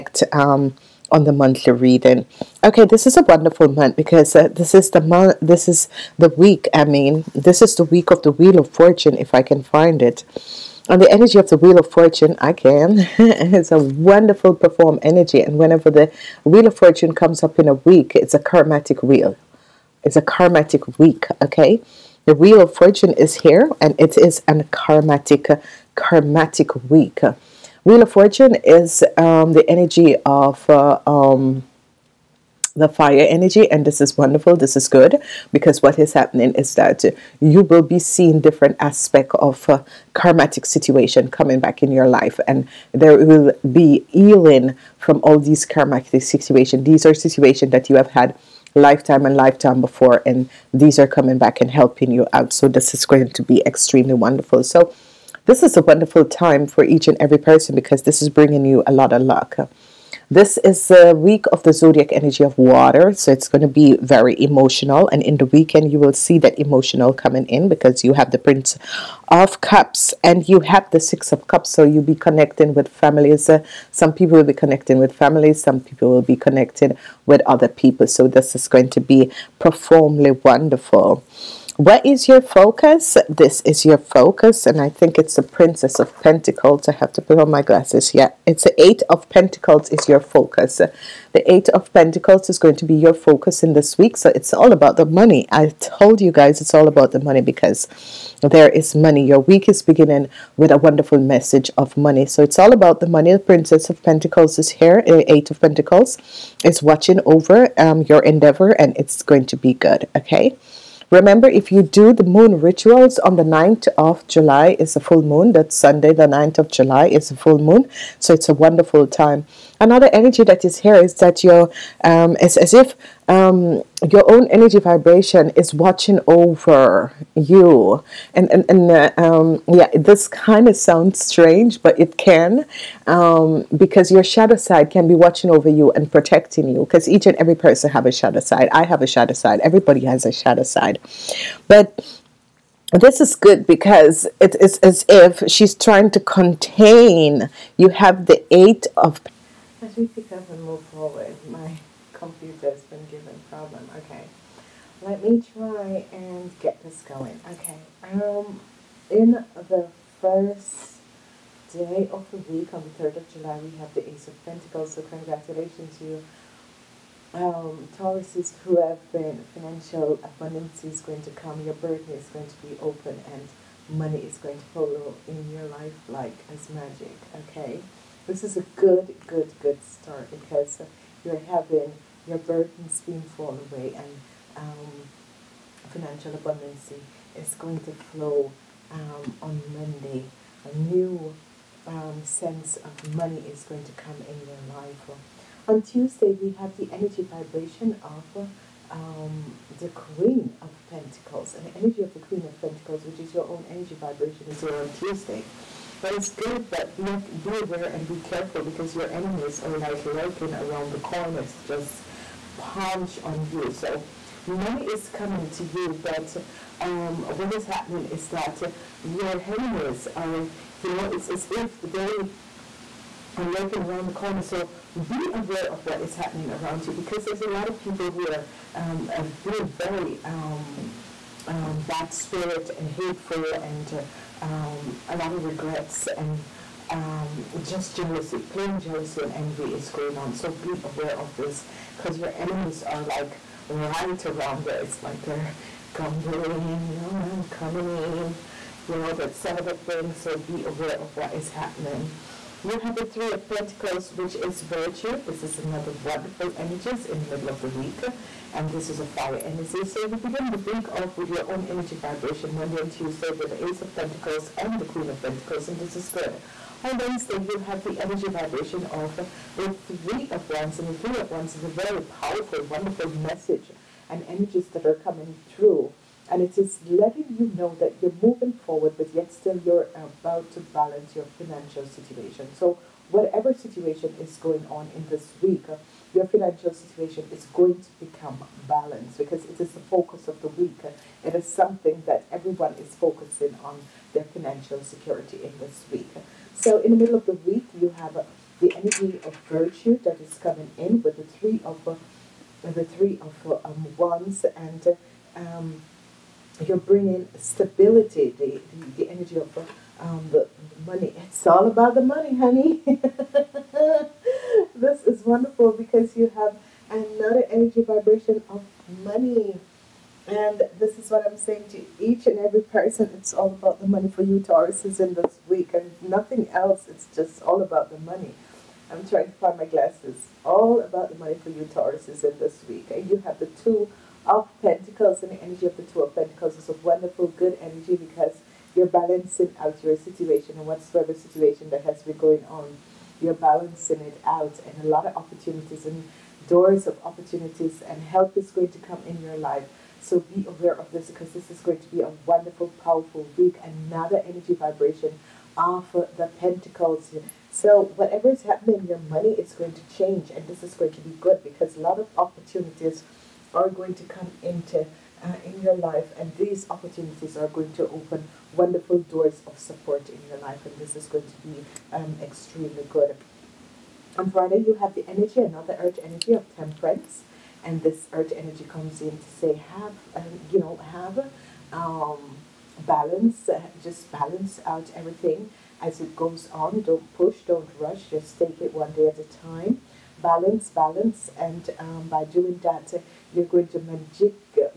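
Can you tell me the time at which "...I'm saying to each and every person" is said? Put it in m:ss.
5:21.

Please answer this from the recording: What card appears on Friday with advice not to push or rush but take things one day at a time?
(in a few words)
Temperance.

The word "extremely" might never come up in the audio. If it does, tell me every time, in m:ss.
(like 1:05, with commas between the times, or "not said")
0:53, 6:12.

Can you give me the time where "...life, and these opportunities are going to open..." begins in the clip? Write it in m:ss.
6:05.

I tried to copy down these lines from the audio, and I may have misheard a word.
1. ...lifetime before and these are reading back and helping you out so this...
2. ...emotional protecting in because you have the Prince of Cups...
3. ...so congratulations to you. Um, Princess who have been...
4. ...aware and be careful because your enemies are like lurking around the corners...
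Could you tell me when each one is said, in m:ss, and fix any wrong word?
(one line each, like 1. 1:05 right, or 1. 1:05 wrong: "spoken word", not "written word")
1. 0:49 wrong: "coming", not "reading"
2. 1:06 wrong: "coming", not "protecting"
3. 2:44 wrong: "Tauruses", not "Princess"
4. 3:27 right.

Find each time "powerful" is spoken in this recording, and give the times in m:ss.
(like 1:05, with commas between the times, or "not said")
4:32, 5:52.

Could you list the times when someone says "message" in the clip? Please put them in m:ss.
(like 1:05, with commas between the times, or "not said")
1:41, 4:33.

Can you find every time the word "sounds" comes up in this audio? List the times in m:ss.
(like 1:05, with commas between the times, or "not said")
2:10.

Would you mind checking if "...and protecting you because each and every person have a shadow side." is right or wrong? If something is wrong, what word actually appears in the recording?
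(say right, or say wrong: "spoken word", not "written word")
right.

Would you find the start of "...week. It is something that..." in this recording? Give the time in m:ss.
4:50.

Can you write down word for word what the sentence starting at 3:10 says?
A new um, sense of money is going to come in your life.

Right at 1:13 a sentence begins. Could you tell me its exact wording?
Uh, some people will be connecting with families, some people will be connecting with other people.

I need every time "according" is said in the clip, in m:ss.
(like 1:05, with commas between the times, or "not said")
not said.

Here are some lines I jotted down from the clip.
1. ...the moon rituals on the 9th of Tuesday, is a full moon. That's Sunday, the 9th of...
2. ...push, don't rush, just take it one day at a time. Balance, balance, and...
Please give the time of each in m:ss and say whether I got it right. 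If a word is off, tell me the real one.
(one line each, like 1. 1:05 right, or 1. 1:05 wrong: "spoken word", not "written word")
1. 1:52 wrong: "July", not "Tuesday"
2. 6:27 right.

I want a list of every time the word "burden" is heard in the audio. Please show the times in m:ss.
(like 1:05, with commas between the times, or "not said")
2:51, 3:02.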